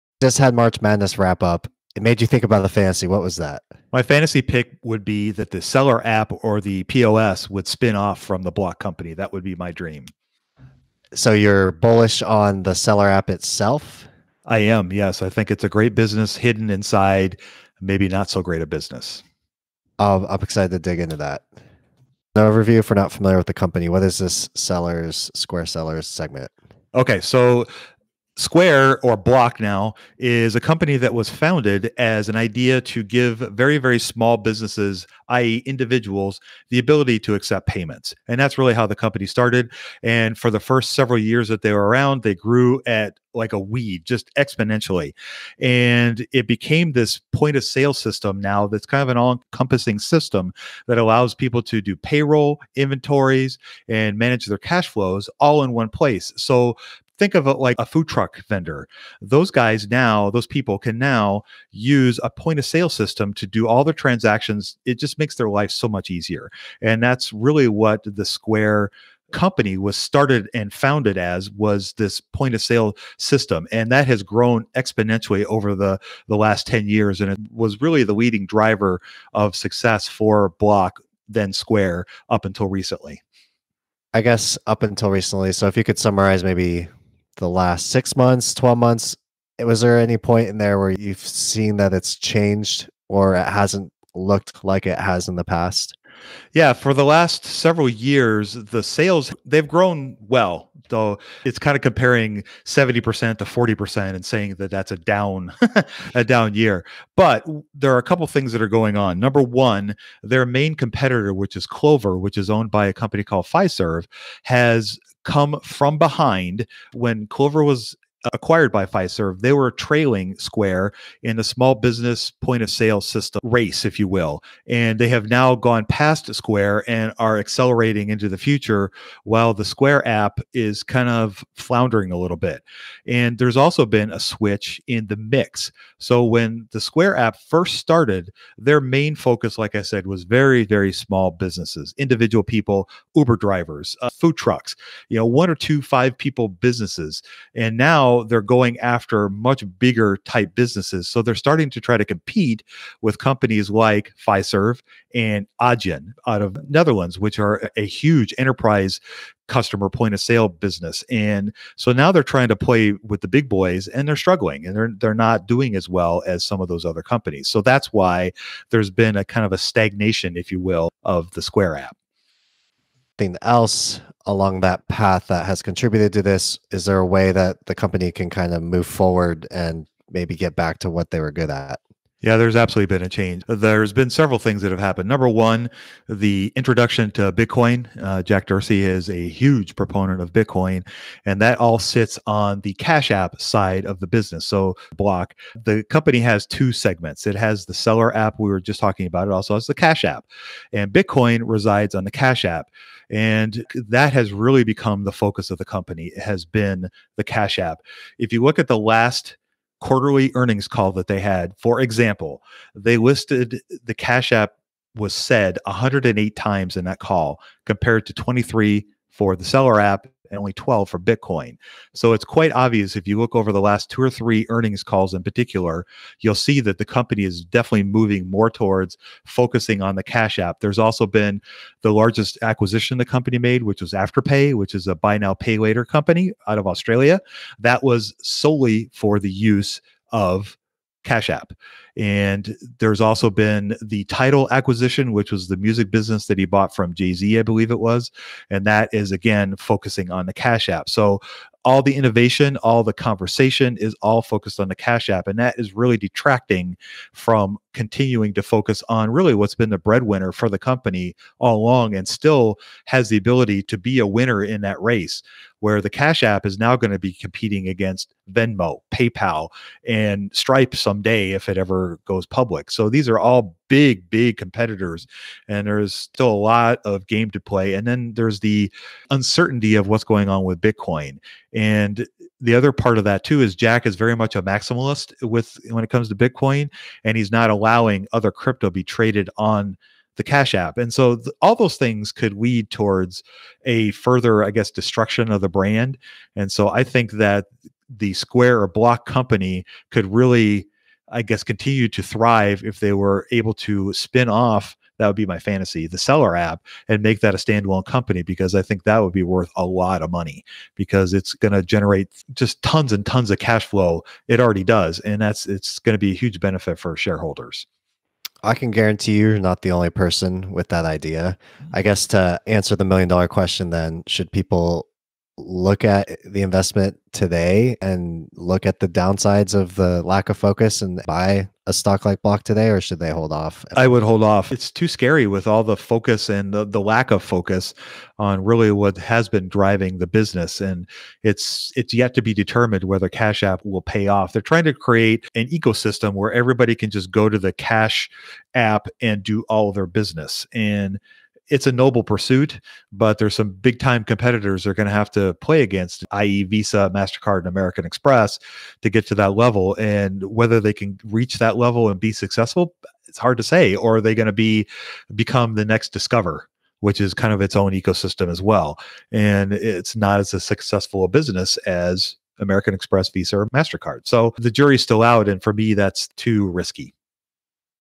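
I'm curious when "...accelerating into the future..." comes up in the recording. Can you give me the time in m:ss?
2:07.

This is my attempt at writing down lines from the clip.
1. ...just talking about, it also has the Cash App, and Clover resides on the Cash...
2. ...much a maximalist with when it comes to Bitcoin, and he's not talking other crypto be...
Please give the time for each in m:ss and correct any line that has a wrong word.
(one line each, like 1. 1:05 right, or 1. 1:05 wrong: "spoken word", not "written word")
1. 3:18 wrong: "Bitcoin", not "Clover"
2. 4:44 wrong: "allowing", not "talking".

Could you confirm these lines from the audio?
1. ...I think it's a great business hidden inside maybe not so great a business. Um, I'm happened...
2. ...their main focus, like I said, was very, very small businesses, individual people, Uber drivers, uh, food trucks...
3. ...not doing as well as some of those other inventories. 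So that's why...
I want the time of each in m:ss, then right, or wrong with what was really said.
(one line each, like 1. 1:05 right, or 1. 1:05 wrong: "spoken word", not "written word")
1. 0:15 wrong: "excited", not "happened"
2. 2:18 right
3. 2:45 wrong: "companies", not "inventories".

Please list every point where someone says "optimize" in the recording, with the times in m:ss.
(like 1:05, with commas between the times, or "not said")
not said.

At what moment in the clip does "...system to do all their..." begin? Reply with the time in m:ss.
1:02.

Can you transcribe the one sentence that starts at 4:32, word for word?
So these are all big, big competitors, and there's still a lot of game to play.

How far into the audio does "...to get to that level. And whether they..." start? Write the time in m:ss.
5:58.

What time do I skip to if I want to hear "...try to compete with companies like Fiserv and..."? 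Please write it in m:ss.
2:31.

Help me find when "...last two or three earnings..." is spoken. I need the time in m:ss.
3:43.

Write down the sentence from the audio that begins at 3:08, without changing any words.
Uh, Jack Dorsey is a huge proponent of Bitcoin, and that all sits on the Cash App side of the business.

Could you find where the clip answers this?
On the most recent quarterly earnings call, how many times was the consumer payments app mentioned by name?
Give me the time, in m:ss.
3:35.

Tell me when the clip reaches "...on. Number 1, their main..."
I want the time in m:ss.
1:48.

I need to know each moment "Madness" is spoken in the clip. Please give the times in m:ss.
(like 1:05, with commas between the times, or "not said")
0:00.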